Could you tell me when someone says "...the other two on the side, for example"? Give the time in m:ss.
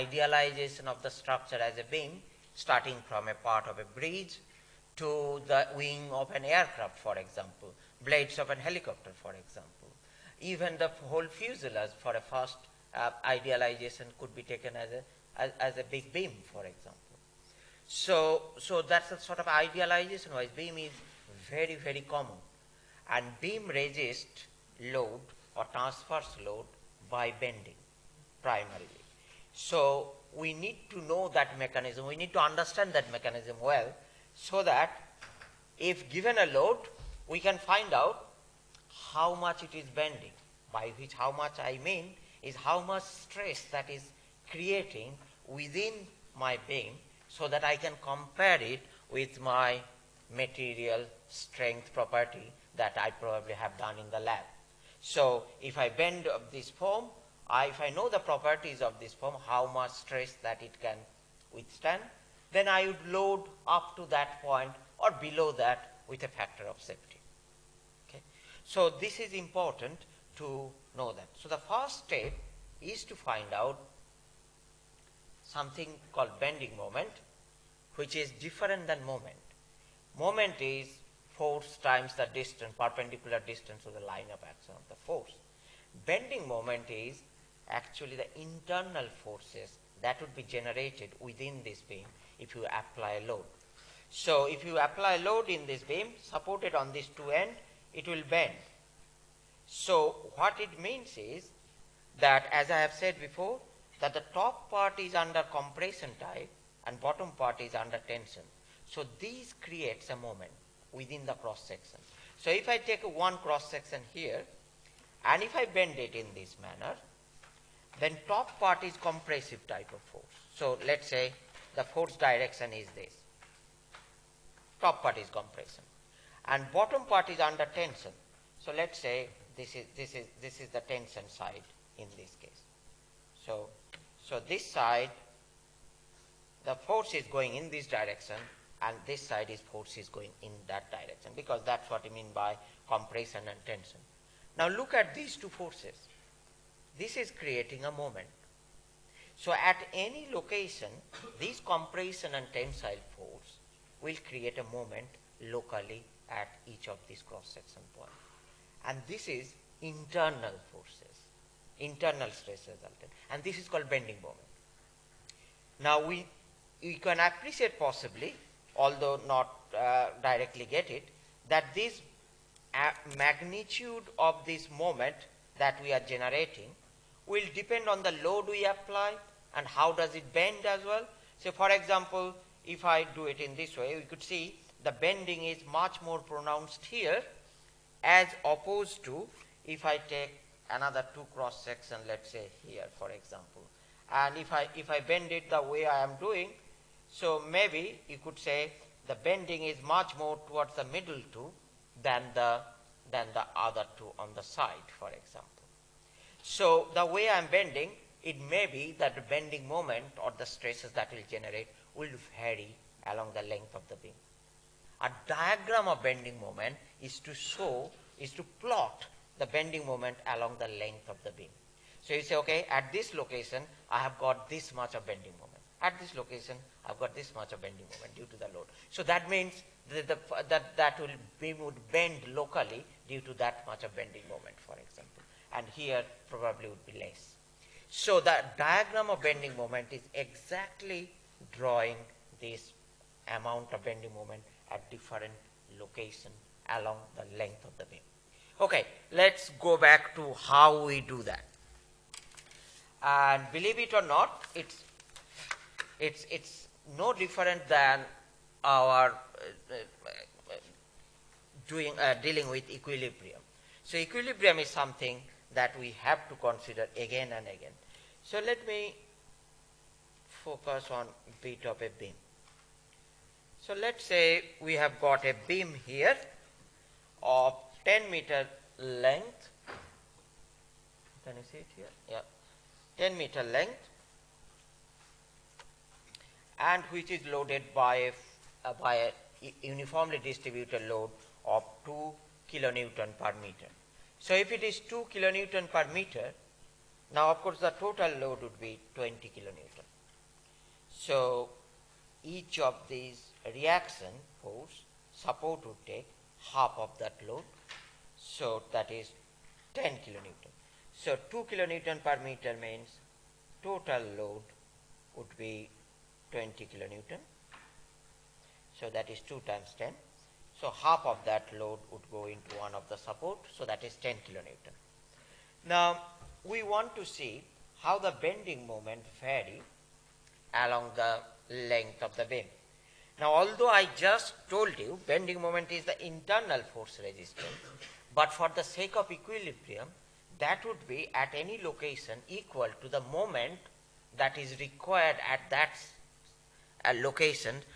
3:23.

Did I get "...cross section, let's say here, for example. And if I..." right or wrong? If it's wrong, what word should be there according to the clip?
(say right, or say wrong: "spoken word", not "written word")
right.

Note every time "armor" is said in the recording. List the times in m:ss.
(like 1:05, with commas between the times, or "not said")
not said.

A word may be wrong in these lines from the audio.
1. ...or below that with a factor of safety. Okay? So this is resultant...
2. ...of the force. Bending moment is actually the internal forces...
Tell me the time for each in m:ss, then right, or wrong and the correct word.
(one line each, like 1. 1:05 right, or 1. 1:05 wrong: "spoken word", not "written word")
1. 1:04 wrong: "important", not "resultant"
2. 1:24 right.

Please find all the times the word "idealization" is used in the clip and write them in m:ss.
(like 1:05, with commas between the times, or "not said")
0:13, 0:19.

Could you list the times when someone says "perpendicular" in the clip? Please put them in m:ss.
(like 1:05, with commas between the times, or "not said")
1:22.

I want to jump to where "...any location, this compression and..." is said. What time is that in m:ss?
2:29.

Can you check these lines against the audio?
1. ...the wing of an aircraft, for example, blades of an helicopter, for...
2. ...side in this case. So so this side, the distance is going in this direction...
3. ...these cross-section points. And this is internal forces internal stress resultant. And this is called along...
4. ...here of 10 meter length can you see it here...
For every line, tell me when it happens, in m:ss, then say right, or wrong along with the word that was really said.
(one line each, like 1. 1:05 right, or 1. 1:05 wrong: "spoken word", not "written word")
1. 0:05 right
2. 2:11 wrong: "force", not "distance"
3. 2:37 wrong: "bending", not "along"
4. 4:35 right.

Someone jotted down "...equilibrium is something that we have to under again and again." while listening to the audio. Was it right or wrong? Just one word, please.
wrong.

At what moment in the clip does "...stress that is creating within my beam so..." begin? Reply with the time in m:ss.
0:43.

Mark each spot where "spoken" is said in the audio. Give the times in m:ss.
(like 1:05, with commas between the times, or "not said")
not said.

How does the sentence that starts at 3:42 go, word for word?
So you say, okay, at this location, I have got this much of bending moment.